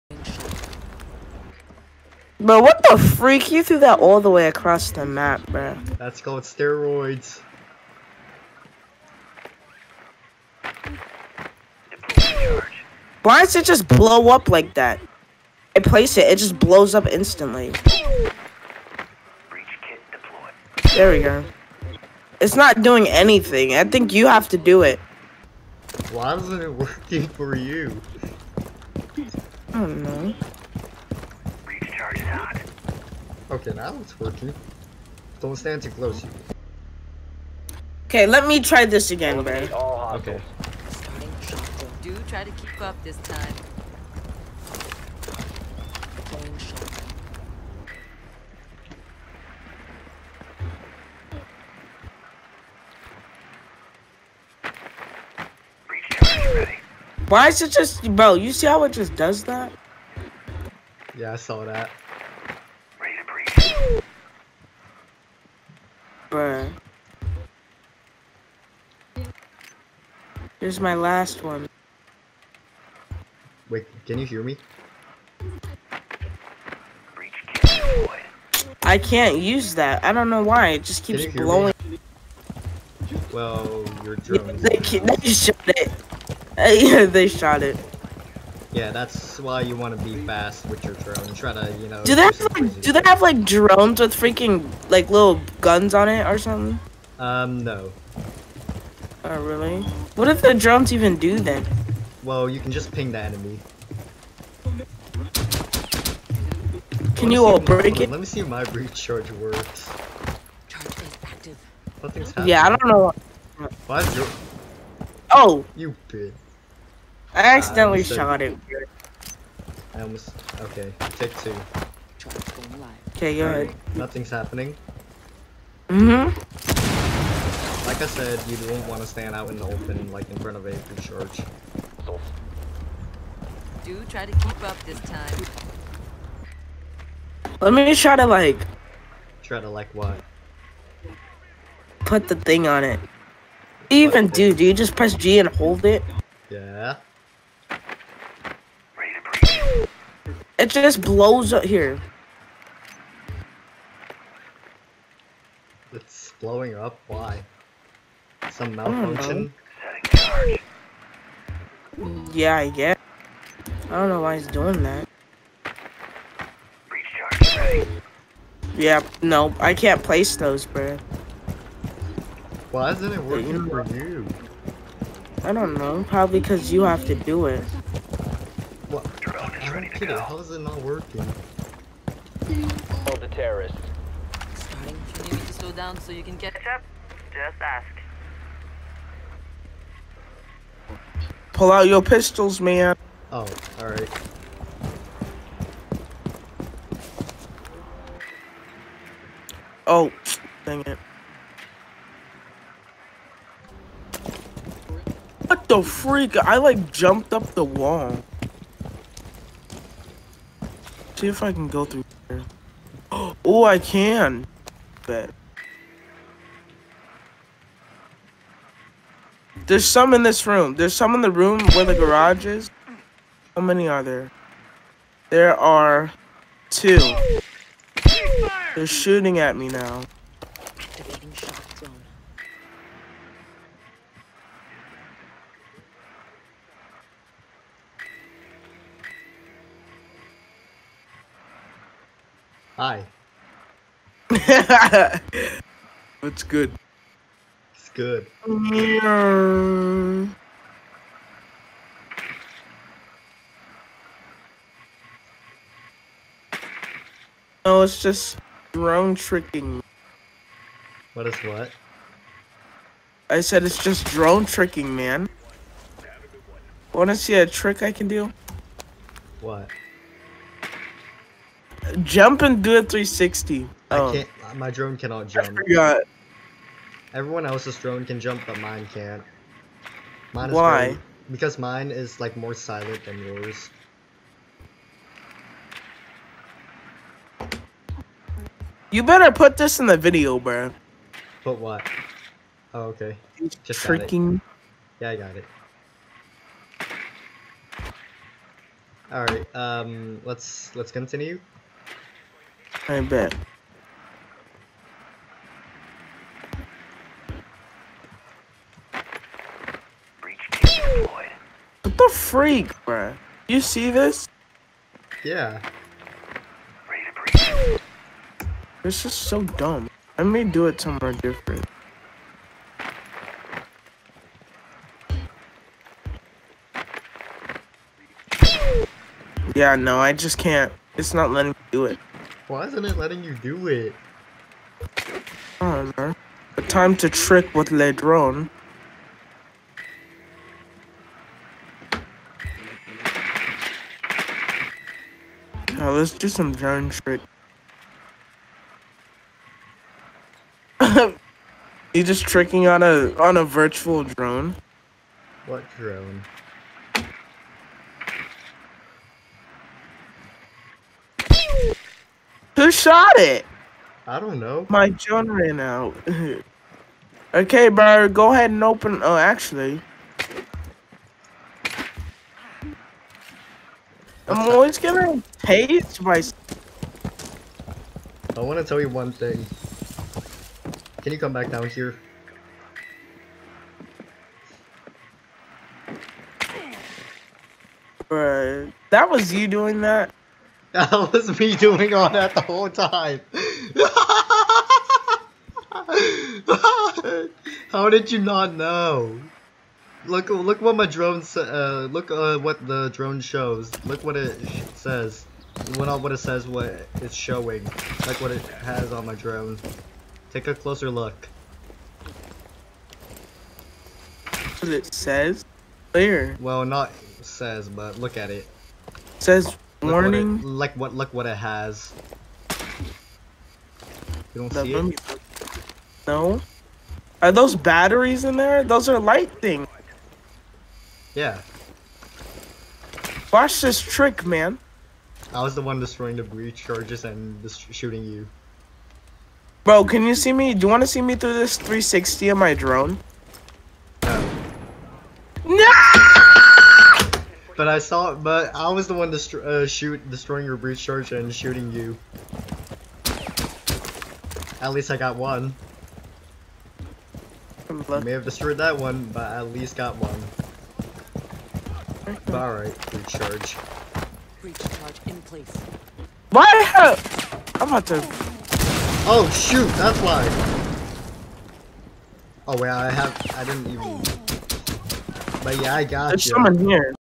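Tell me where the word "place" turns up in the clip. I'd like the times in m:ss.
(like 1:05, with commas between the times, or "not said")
0:15, 2:50, 7:45.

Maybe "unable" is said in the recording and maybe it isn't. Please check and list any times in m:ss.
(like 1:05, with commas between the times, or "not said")
not said.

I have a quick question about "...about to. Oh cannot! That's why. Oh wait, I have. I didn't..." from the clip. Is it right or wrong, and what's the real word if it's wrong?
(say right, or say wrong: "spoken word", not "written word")
wrong: "shoot", not "cannot".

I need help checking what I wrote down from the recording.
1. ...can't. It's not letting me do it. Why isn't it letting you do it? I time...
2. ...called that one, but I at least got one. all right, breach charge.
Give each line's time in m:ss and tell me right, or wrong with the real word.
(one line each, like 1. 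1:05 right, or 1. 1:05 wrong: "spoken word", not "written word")
1. 5:30 right
2. 7:38 wrong: "destroyed", not "called".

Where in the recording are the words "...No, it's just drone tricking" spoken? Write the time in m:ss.
4:17.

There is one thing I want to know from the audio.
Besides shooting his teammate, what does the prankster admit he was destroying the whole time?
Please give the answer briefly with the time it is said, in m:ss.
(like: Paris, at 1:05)
The breach charges, at 7:16.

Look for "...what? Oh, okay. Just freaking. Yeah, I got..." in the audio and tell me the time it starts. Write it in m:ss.
4:51.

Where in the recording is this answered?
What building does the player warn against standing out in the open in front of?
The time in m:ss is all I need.
2:10.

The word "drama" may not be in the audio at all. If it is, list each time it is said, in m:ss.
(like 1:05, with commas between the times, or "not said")
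not said.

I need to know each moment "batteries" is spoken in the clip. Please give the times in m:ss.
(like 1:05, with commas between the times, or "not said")
7:07.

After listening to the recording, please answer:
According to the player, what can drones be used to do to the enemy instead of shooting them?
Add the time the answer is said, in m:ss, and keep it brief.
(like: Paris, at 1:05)
Ping the enemy, at 1:42.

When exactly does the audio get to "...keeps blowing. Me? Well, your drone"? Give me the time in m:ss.
1:21.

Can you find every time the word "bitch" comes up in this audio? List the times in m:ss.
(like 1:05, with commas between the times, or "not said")
1:56.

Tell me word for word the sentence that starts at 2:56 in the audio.
Probably because you have to do it ready to go.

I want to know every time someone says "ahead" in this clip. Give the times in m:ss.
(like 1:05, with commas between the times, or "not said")
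2:03, 6:08.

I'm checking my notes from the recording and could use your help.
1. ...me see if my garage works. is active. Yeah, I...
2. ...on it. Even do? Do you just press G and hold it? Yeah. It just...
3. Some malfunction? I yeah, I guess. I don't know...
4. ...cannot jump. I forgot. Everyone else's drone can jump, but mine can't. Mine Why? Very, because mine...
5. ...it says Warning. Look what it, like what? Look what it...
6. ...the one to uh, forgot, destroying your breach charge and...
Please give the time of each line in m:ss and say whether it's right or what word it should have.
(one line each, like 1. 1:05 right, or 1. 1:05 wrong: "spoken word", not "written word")
1. 1:48 wrong: "recharge", not "garage"
2. 2:22 right
3. 2:38 right
4. 4:34 right
5. 6:58 right
6. 7:28 wrong: "shoot", not "forgot".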